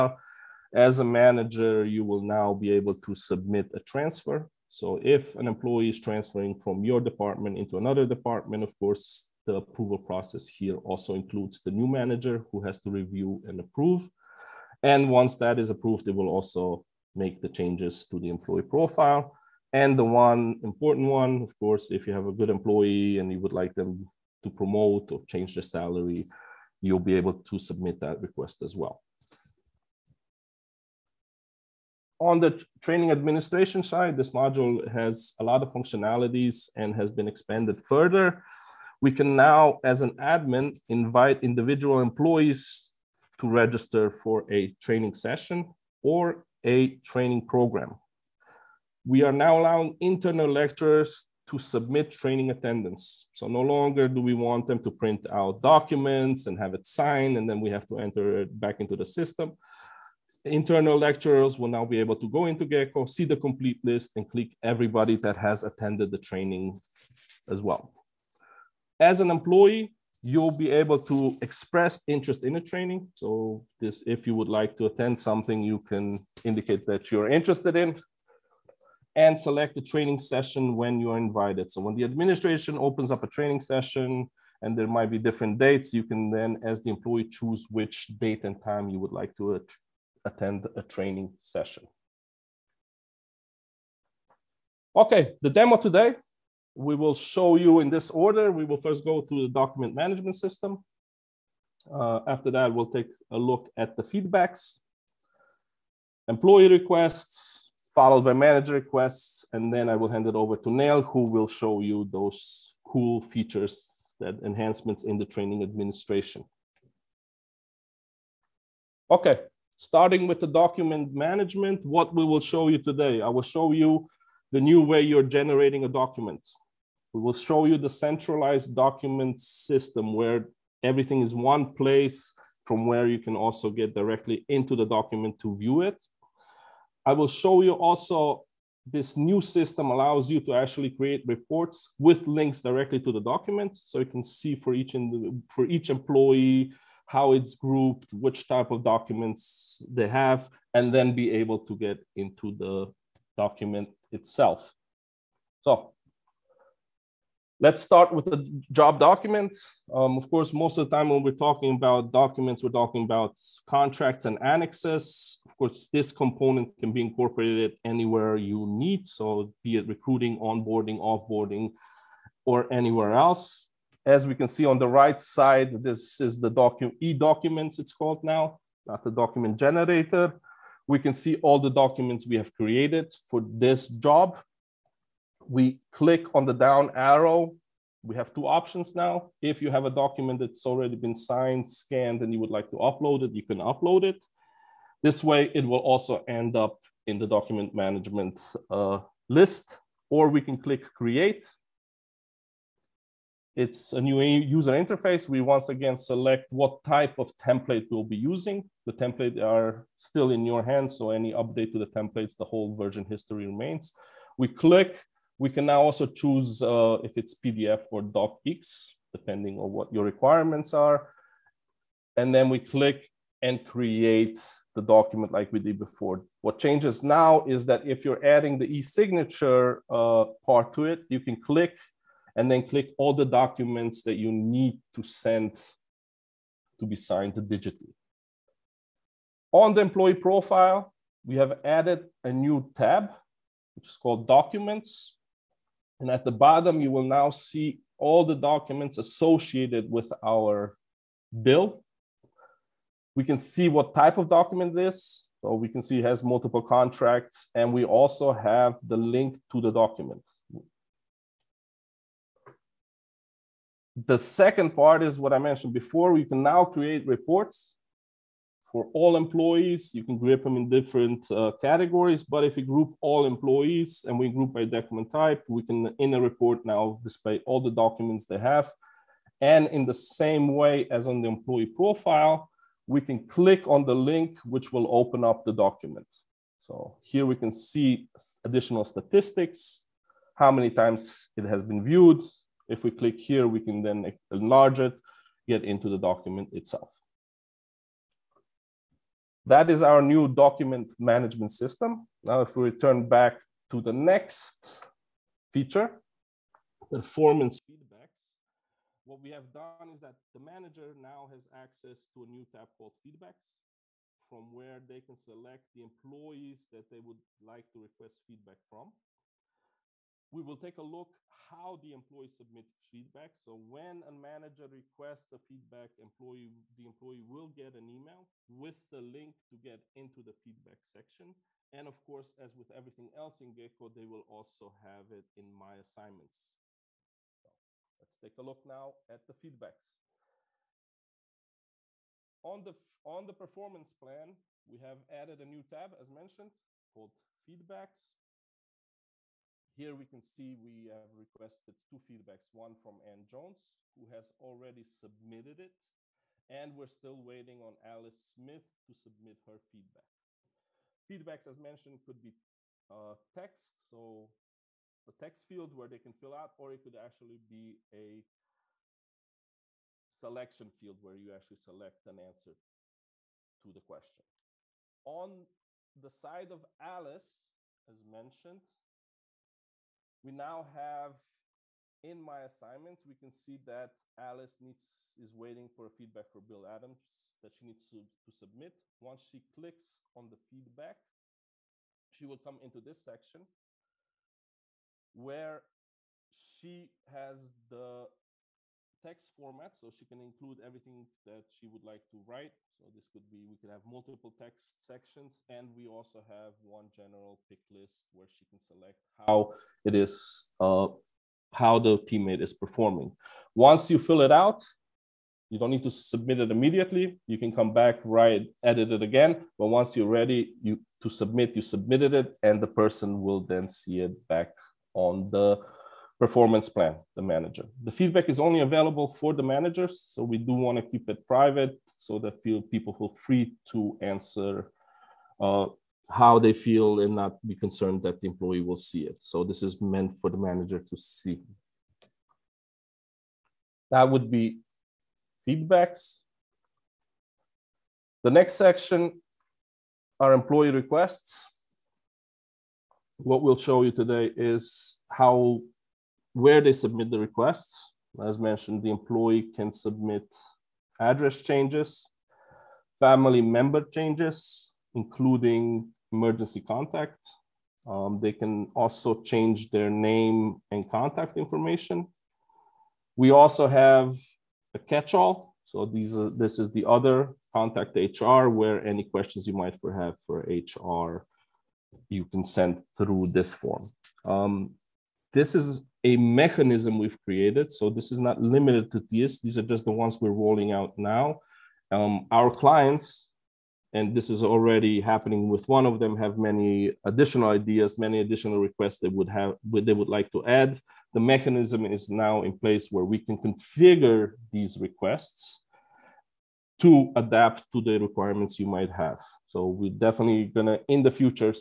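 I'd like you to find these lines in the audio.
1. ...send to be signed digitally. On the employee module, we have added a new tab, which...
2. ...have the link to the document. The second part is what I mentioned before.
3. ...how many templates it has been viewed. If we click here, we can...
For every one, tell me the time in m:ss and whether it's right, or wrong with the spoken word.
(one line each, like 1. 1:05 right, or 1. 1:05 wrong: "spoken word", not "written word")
1. 3:55 wrong: "profile", not "module"
2. 4:18 right
3. 4:50 wrong: "times", not "templates".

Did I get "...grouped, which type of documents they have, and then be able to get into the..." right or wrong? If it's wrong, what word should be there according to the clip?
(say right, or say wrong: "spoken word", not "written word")
right.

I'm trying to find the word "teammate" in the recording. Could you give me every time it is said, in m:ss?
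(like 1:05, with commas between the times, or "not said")
6:51.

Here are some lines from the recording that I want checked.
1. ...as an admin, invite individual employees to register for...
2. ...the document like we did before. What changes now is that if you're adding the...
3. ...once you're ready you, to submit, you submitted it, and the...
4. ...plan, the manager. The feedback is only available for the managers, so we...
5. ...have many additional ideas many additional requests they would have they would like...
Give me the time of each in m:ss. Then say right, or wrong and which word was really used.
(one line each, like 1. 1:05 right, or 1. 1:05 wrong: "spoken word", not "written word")
1. 0:39 right
2. 3:44 right
3. 6:59 right
4. 7:06 right
5. 8:16 right.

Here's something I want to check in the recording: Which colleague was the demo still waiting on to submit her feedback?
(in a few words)
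Alice Smith.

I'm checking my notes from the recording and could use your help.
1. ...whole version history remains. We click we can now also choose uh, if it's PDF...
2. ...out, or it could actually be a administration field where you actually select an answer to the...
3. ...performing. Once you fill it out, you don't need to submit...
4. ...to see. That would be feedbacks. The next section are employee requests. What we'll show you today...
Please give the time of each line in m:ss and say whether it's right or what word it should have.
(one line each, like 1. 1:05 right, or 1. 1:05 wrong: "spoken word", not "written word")
1. 3:32 right
2. 6:06 wrong: "selection", not "administration"
3. 6:52 right
4. 7:20 right.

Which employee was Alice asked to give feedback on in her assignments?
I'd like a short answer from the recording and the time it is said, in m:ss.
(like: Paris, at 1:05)
Bill Adams, at 6:26.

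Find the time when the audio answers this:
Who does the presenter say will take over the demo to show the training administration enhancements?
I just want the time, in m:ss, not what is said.
1:50.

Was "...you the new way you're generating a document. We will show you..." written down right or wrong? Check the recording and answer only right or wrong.
right.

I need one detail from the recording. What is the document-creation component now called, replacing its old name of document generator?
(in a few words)
e-documents.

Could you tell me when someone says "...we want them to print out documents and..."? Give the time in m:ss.
0:54.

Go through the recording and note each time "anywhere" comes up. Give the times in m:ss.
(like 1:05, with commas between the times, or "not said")
2:47, 2:52.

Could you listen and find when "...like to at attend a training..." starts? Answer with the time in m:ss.
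1:29.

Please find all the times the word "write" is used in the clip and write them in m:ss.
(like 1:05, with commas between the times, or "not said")
6:42, 6:58.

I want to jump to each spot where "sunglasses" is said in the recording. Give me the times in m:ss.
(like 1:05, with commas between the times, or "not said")
not said.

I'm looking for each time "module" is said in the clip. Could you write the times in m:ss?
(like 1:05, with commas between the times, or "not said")
0:34.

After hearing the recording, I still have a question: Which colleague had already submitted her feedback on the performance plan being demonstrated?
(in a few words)
Ann Jones.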